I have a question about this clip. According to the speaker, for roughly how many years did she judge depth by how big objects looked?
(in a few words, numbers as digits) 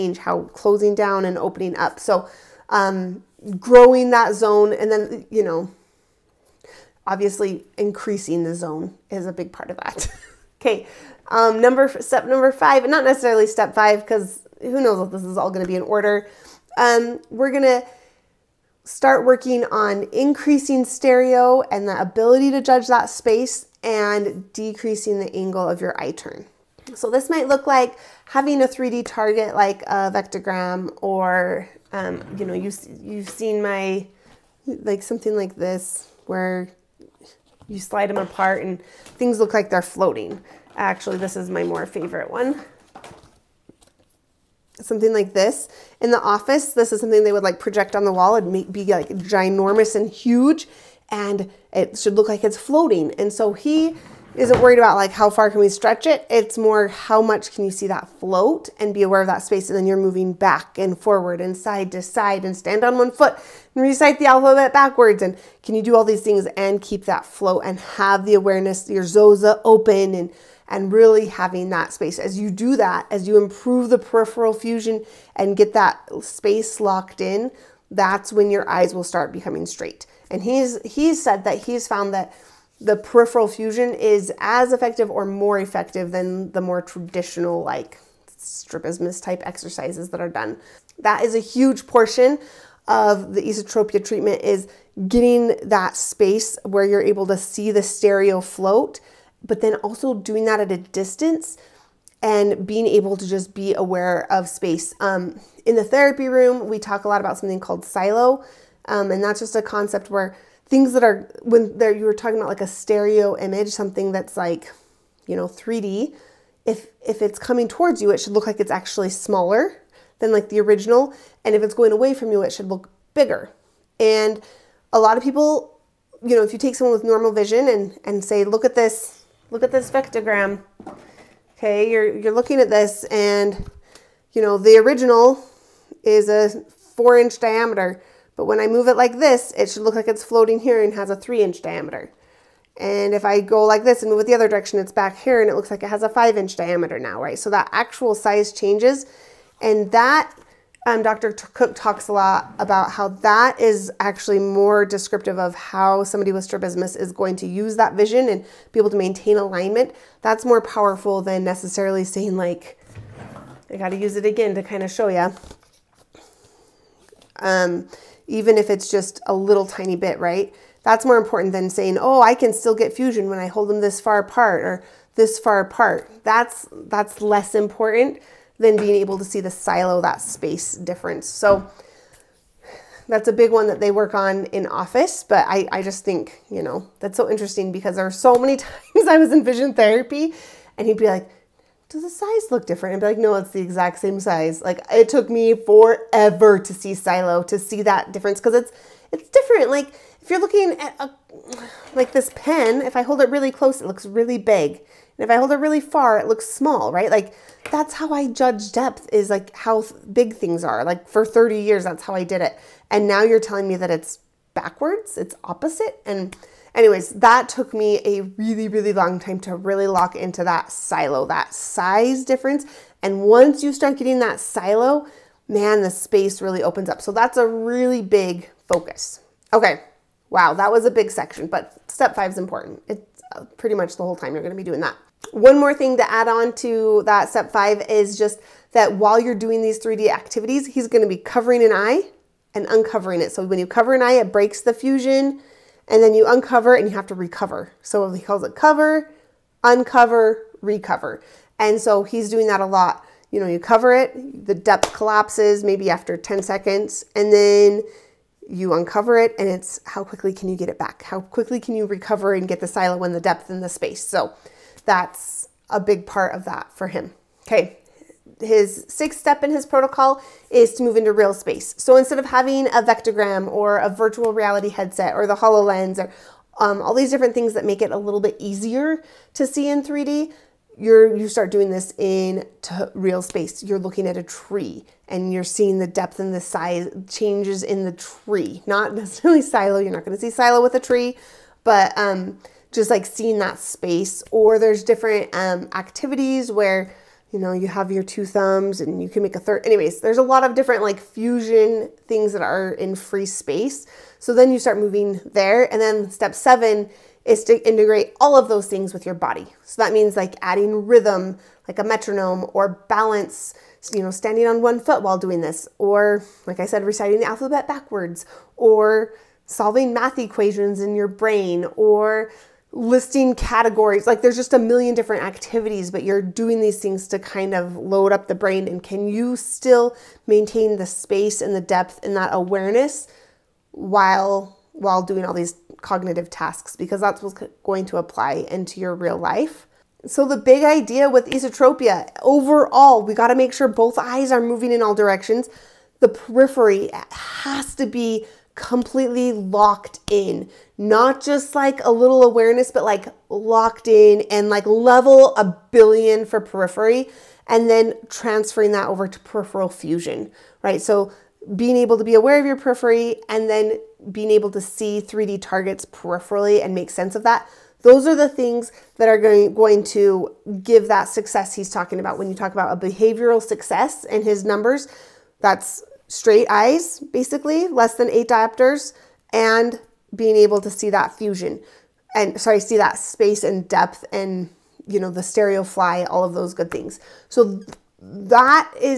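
30.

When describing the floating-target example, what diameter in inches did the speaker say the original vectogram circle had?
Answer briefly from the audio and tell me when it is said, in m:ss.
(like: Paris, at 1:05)
4 inches, at 2:16.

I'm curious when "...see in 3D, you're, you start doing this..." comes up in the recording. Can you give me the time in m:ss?
4:39.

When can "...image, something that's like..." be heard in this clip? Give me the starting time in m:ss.
1:53.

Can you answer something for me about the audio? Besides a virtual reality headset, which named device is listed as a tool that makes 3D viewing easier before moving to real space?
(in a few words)
HoloLens.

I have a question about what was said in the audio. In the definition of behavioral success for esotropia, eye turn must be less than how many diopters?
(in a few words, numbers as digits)
8.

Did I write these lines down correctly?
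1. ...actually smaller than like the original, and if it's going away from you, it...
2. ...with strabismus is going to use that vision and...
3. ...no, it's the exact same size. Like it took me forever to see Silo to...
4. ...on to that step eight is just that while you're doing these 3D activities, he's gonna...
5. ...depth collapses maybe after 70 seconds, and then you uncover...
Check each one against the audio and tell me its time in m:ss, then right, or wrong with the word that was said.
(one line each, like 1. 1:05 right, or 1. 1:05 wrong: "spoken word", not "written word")
1. 1:58 right
2. 2:36 right
3. 3:13 right
4. 3:56 wrong: "five", not "eight"
5. 4:14 wrong: "10", not "70".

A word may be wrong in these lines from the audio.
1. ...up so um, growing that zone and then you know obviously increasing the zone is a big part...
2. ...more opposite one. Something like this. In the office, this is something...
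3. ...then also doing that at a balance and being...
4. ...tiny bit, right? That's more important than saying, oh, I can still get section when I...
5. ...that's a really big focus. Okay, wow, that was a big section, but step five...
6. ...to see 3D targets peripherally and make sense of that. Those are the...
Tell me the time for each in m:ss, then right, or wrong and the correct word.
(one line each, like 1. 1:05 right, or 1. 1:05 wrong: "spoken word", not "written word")
1. 0:01 right
2. 0:41 wrong: "favorite", not "opposite"
3. 1:39 wrong: "distance", not "balance"
4. 2:49 wrong: "fusion", not "section"
5. 3:47 right
6. 6:04 right.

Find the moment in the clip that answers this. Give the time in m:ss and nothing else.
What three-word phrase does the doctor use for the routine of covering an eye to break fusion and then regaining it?
4:08.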